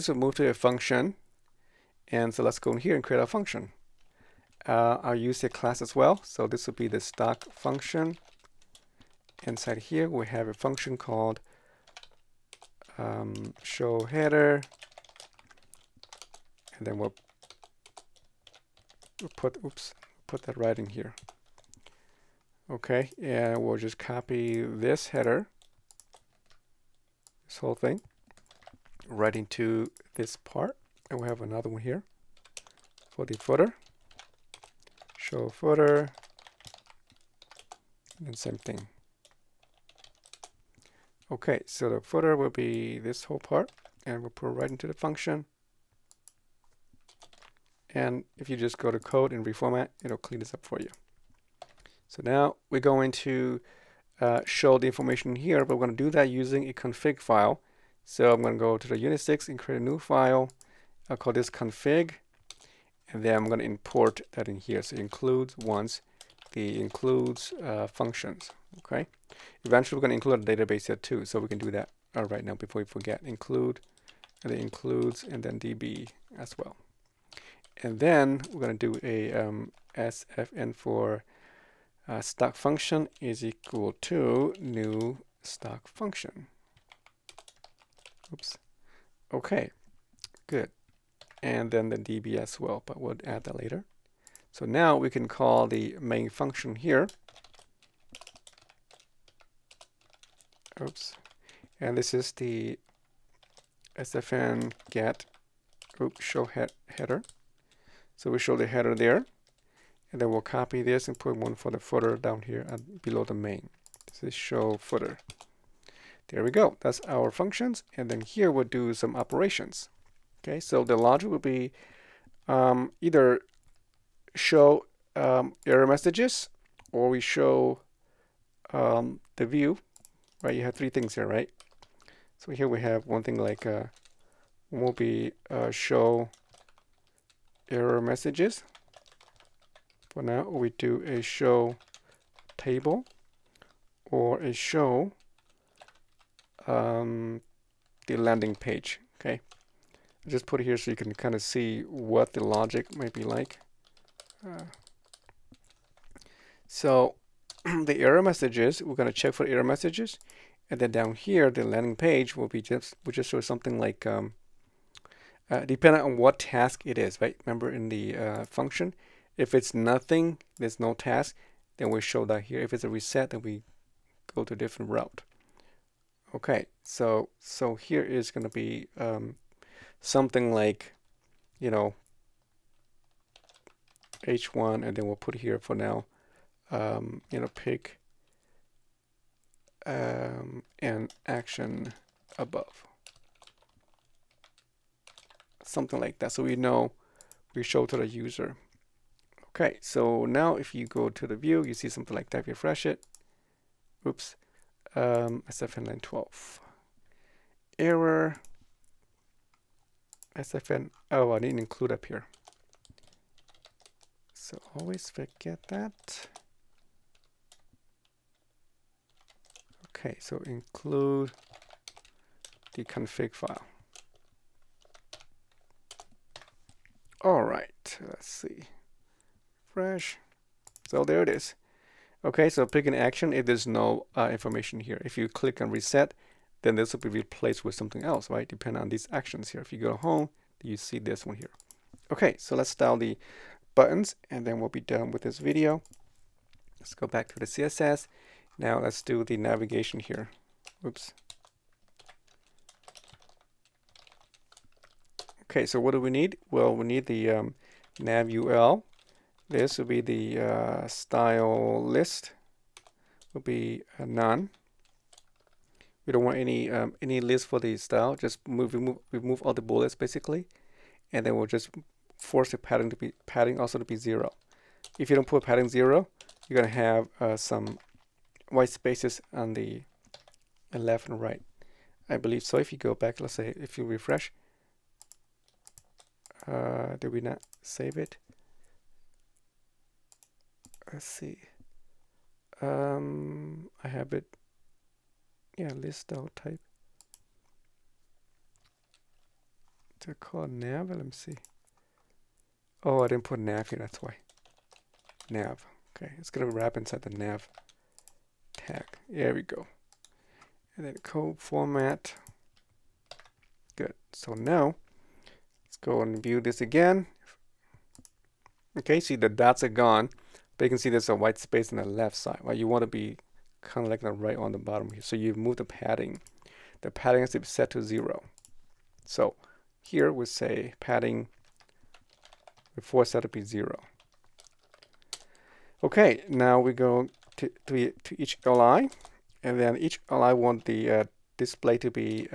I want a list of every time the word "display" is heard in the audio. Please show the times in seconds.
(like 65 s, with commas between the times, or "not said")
341 s.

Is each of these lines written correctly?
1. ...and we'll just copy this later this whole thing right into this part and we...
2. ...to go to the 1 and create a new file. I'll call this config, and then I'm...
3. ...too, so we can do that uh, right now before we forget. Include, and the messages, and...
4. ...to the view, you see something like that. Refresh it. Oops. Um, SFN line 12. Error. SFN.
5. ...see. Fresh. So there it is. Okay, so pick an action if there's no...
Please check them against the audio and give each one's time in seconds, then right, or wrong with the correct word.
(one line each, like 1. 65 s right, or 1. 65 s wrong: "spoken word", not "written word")
1. 23 s wrong: "header", not "later"
2. 58 s wrong: "6", not "1"
3. 70 s wrong: "includes", not "messages"
4. 201 s right
5. 228 s right.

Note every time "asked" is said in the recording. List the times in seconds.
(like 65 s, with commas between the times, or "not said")
not said.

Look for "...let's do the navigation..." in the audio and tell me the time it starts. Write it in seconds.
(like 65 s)
248 s.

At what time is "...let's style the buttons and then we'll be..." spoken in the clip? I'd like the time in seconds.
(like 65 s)
242 s.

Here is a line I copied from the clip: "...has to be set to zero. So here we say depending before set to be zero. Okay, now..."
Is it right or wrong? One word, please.
wrong.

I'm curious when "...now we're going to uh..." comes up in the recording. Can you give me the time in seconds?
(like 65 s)
52 s.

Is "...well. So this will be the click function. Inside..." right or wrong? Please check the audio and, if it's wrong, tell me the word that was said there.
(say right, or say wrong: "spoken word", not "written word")
wrong: "stock", not "click".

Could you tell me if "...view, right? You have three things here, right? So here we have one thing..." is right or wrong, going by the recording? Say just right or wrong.
right.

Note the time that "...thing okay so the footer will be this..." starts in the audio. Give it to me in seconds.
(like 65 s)
38 s.